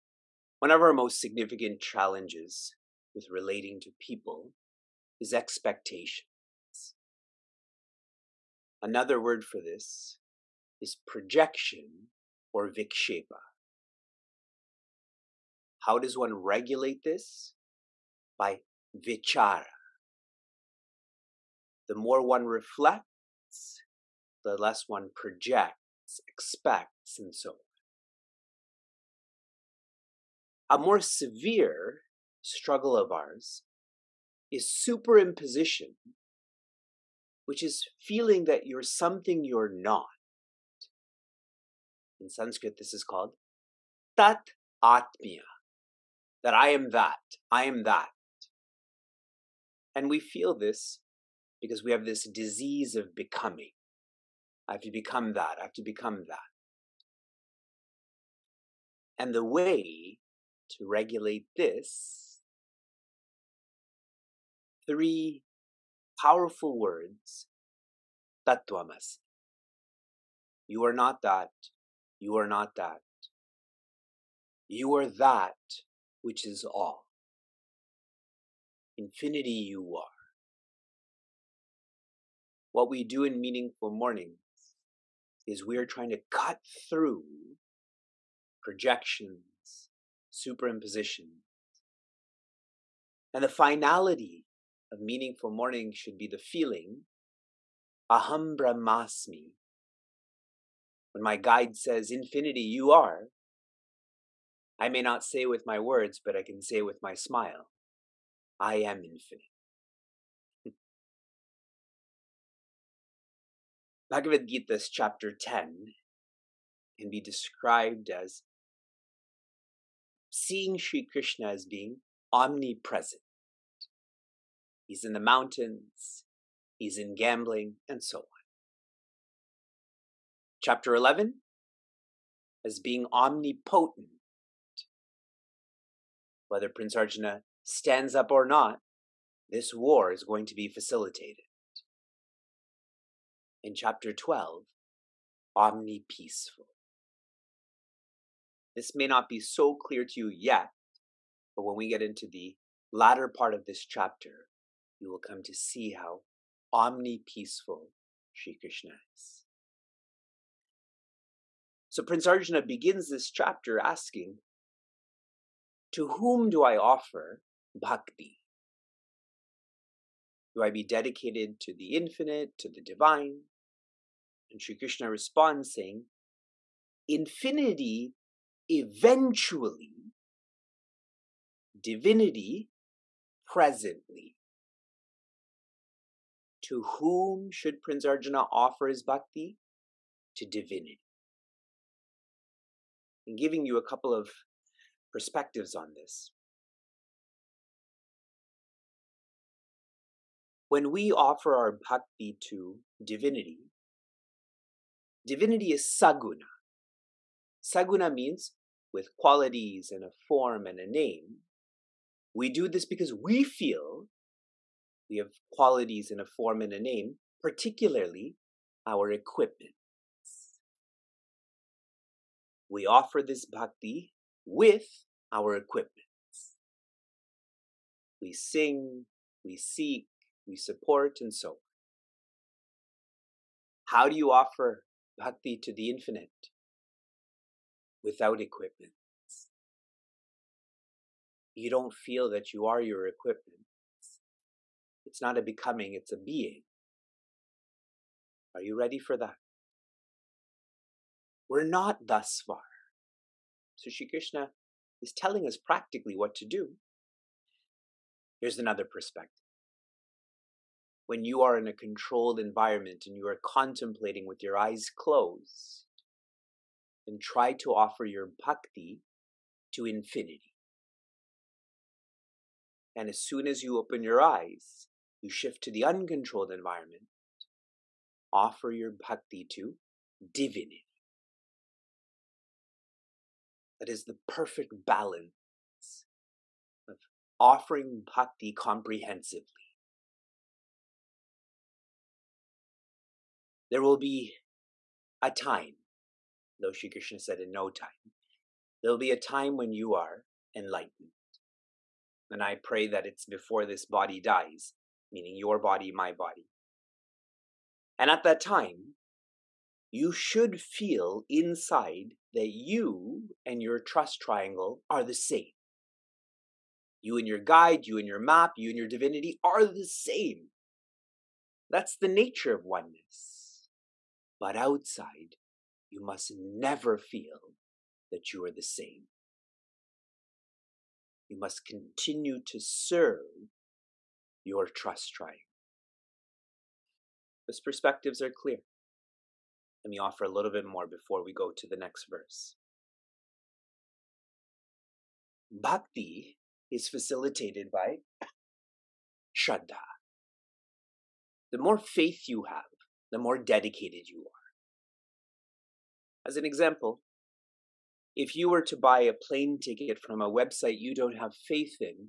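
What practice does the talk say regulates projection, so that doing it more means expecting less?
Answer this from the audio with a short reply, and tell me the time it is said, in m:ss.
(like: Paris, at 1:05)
vichara, at 0:19.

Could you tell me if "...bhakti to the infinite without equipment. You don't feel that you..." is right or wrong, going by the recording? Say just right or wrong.
right.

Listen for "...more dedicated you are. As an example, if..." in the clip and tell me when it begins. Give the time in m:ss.
5:53.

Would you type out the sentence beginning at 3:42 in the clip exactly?
We offer this bhakti with our equipment.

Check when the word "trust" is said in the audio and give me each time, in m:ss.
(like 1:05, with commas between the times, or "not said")
5:13, 5:34.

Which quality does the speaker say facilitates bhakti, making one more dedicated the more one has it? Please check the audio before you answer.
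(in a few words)
Shraddha.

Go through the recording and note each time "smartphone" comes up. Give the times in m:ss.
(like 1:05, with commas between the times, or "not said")
not said.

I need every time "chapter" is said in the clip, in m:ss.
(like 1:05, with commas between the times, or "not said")
1:54, 2:10, 2:23, 2:33, 2:43.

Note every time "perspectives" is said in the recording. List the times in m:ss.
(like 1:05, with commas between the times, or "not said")
3:15, 4:18, 5:37.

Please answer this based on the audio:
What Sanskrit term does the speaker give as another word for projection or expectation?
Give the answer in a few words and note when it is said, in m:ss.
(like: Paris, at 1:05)
vikshepa, at 0:12.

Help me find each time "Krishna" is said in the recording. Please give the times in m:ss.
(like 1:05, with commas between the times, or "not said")
2:01, 2:38, 2:54, 4:14, 4:56.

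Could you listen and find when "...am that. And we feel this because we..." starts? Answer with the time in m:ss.
0:47.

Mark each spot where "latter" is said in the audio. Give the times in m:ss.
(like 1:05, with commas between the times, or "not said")
2:32.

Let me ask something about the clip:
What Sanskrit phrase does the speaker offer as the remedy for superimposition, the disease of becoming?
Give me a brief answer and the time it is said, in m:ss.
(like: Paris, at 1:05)
tattvamasi, at 1:08.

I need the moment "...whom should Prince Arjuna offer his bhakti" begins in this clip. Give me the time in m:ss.
3:06.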